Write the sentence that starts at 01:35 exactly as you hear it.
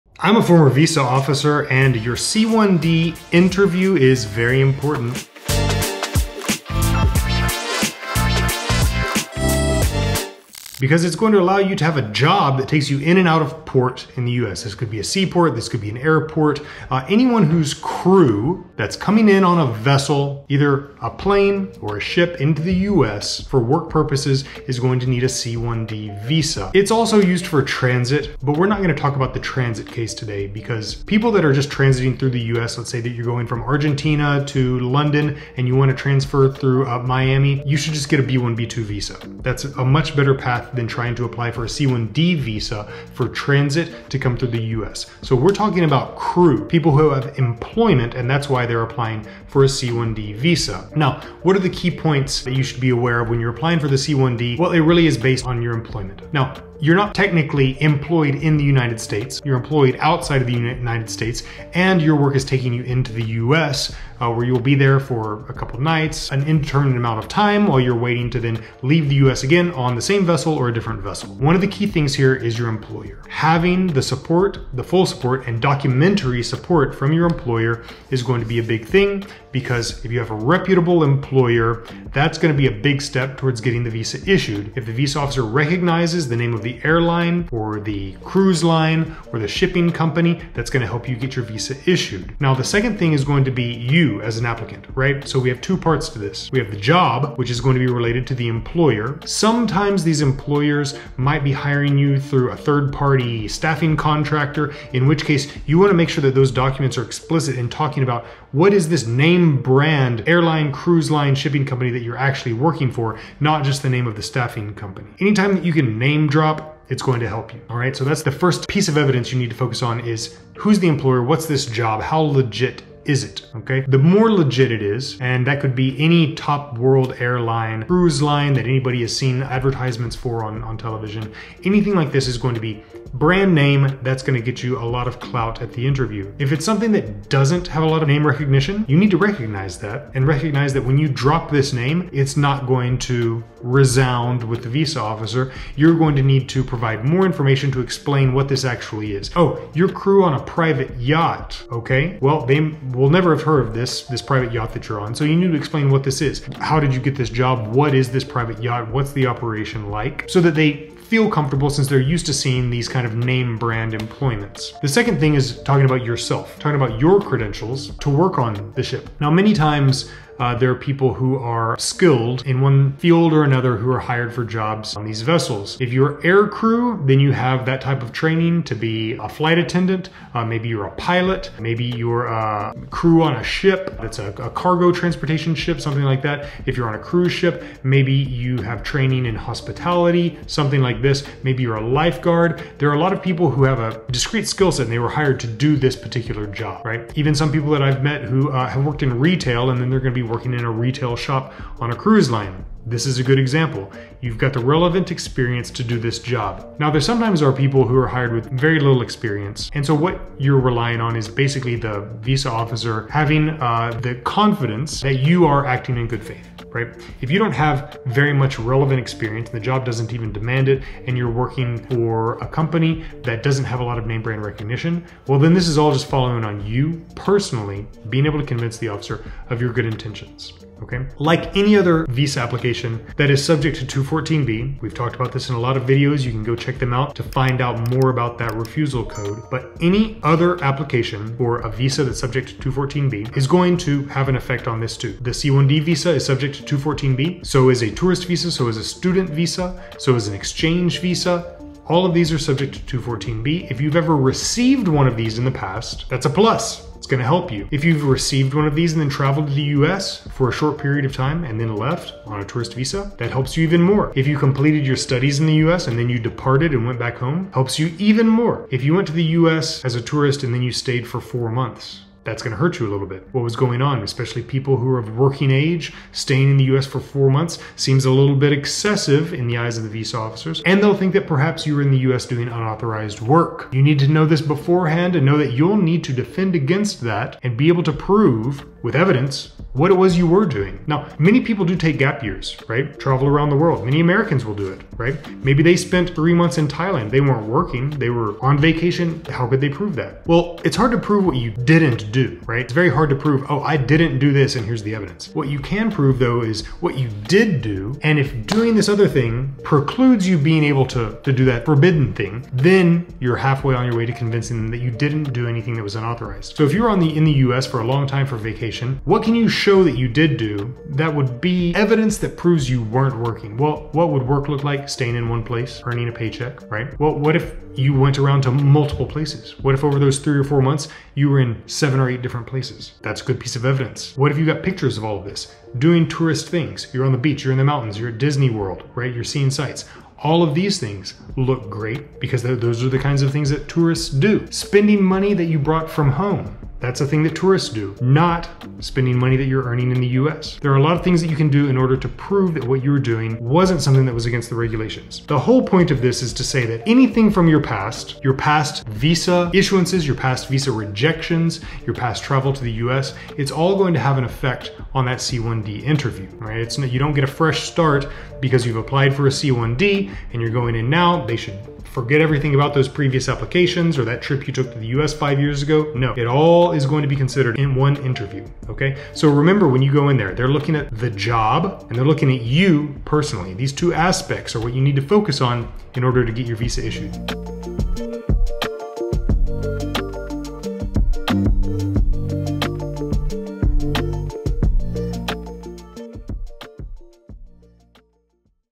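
So we have two parts to this.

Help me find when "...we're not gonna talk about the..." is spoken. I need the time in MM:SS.
00:28.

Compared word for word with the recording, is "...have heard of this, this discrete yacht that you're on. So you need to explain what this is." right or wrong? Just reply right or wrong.
wrong.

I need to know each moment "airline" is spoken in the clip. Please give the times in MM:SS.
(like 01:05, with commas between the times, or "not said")
01:26, 01:50, 02:07.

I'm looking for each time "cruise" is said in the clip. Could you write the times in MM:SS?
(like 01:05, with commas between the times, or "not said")
01:28, 01:50, 02:07, 03:06, 03:21.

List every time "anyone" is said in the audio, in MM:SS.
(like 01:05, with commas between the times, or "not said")
00:17.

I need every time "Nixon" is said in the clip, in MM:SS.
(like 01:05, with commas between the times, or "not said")
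not said.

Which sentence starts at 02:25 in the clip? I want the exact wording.
You're going to need to provide more information to explain what this actually is.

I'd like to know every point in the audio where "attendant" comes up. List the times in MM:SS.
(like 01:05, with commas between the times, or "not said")
02:59.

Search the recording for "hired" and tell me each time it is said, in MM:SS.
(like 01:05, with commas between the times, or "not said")
02:53, 03:15, 03:28.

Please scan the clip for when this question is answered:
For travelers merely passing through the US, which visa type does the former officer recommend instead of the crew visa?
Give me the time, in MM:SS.
00:38.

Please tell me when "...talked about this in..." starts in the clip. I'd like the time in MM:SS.
03:54.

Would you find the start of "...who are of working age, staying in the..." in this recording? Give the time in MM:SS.
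04:34.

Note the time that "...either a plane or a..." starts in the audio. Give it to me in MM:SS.
00:20.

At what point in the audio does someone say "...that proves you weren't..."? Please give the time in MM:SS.
05:22.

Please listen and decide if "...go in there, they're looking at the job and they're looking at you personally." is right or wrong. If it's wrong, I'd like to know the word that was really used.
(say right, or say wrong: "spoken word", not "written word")
right.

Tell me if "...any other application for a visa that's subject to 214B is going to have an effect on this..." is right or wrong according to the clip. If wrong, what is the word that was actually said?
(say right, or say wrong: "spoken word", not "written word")
right.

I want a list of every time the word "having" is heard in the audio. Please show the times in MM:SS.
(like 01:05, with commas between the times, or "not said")
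01:13, 03:33.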